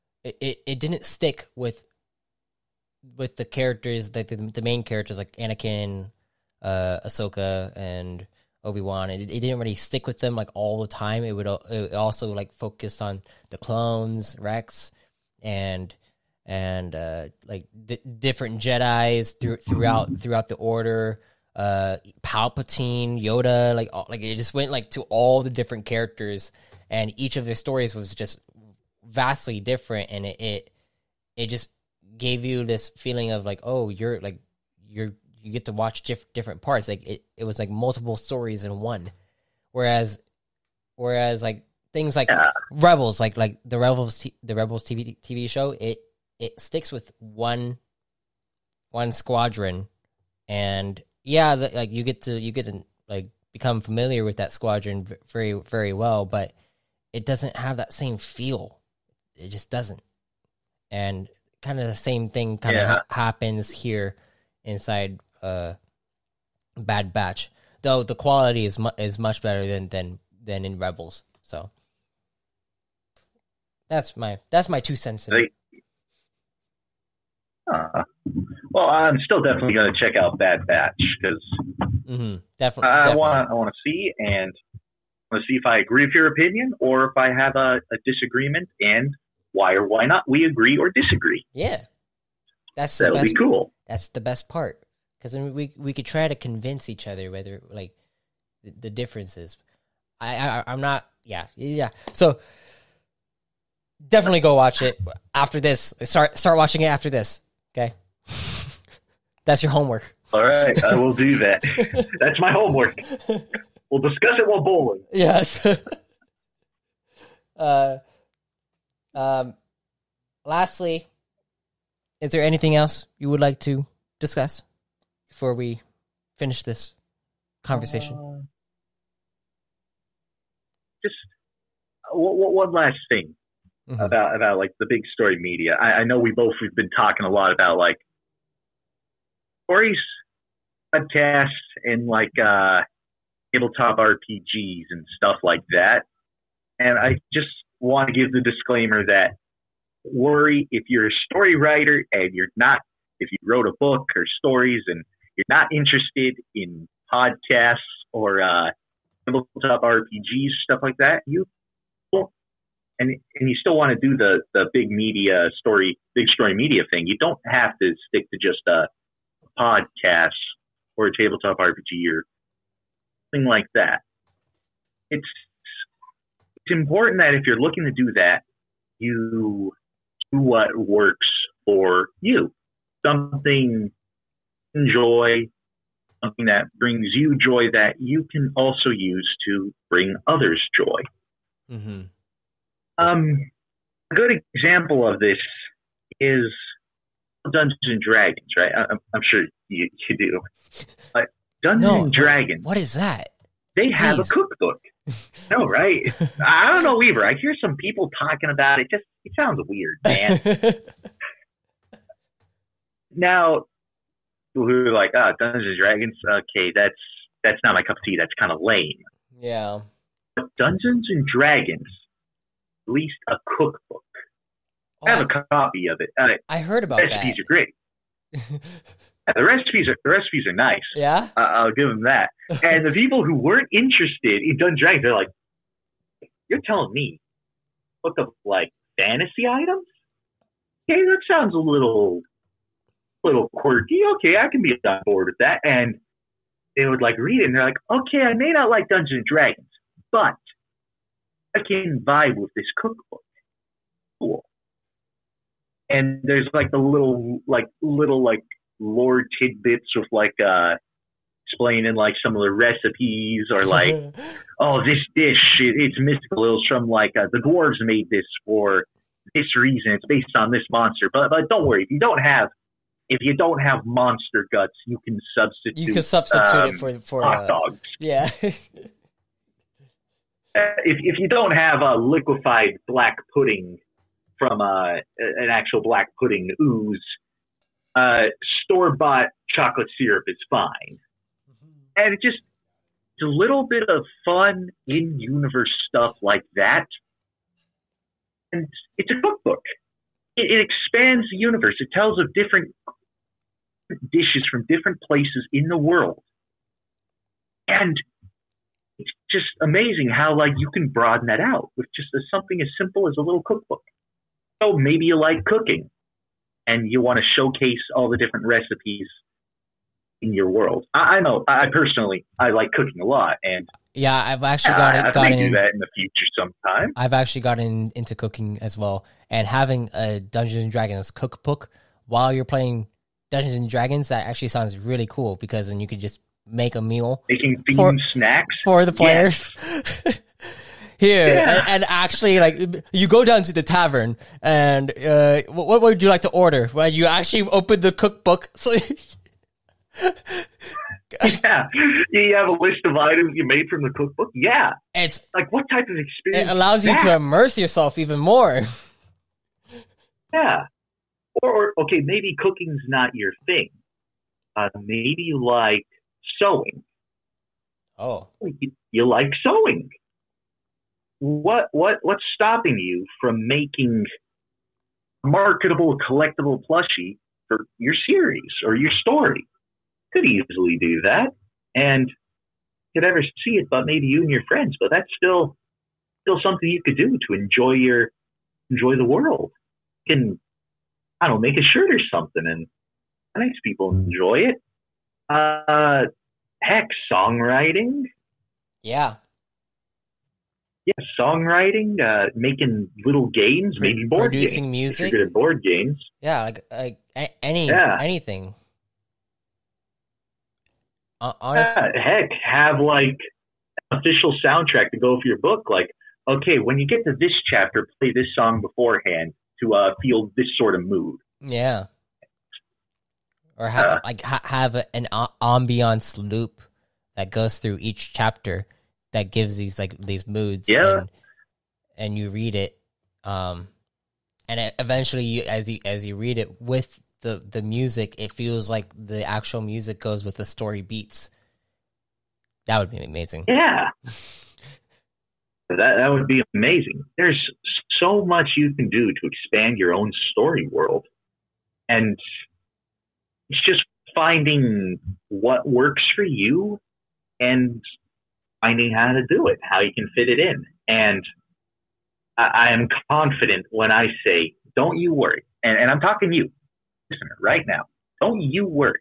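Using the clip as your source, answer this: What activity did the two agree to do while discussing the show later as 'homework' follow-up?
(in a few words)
Bowling.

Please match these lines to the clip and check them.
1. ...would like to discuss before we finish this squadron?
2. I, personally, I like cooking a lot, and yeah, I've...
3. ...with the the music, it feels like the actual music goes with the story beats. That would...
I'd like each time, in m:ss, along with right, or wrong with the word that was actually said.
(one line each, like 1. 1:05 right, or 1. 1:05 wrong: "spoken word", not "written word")
1. 2:03 wrong: "conversation", not "squadron"
2. 5:21 right
3. 7:16 right.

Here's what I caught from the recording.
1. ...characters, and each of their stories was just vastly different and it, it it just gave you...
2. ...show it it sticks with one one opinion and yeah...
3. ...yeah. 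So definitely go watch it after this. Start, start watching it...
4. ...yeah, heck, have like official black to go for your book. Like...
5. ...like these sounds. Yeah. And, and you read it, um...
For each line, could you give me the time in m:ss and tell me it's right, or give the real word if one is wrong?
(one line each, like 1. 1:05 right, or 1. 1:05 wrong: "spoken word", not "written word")
1. 0:25 right
2. 0:45 wrong: "squadron", not "opinion"
3. 1:41 right
4. 6:51 wrong: "soundtrack", not "black"
5. 7:09 wrong: "moods", not "sounds".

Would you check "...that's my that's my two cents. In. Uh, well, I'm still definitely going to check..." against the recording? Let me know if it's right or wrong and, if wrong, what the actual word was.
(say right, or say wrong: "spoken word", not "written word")
right.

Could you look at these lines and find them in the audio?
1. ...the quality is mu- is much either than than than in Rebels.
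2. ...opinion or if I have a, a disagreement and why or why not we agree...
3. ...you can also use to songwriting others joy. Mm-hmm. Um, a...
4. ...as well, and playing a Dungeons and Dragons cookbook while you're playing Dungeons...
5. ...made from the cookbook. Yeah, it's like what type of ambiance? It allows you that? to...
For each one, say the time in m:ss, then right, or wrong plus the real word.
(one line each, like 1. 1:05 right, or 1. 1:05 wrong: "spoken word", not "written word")
1. 1:08 wrong: "better", not "either"
2. 1:26 right
3. 3:07 wrong: "bring", not "songwriting"
4. 5:28 wrong: "having", not "playing"
5. 5:53 wrong: "experience", not "ambiance".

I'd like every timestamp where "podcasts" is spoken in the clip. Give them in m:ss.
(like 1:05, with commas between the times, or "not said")
2:20, 2:37, 2:49.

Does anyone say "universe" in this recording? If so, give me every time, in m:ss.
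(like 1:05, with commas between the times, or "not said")
4:55, 5:01.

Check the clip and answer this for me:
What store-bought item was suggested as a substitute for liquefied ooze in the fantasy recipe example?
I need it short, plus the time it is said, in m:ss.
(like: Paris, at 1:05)
Chocolate syrup, at 4:49.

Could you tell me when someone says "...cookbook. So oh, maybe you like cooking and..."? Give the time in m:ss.
5:13.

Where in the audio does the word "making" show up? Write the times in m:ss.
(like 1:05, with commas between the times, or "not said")
5:37, 6:13, 6:42.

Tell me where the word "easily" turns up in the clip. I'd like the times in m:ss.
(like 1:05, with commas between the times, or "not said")
6:20.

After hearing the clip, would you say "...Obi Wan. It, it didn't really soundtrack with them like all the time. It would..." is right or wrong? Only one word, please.
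wrong.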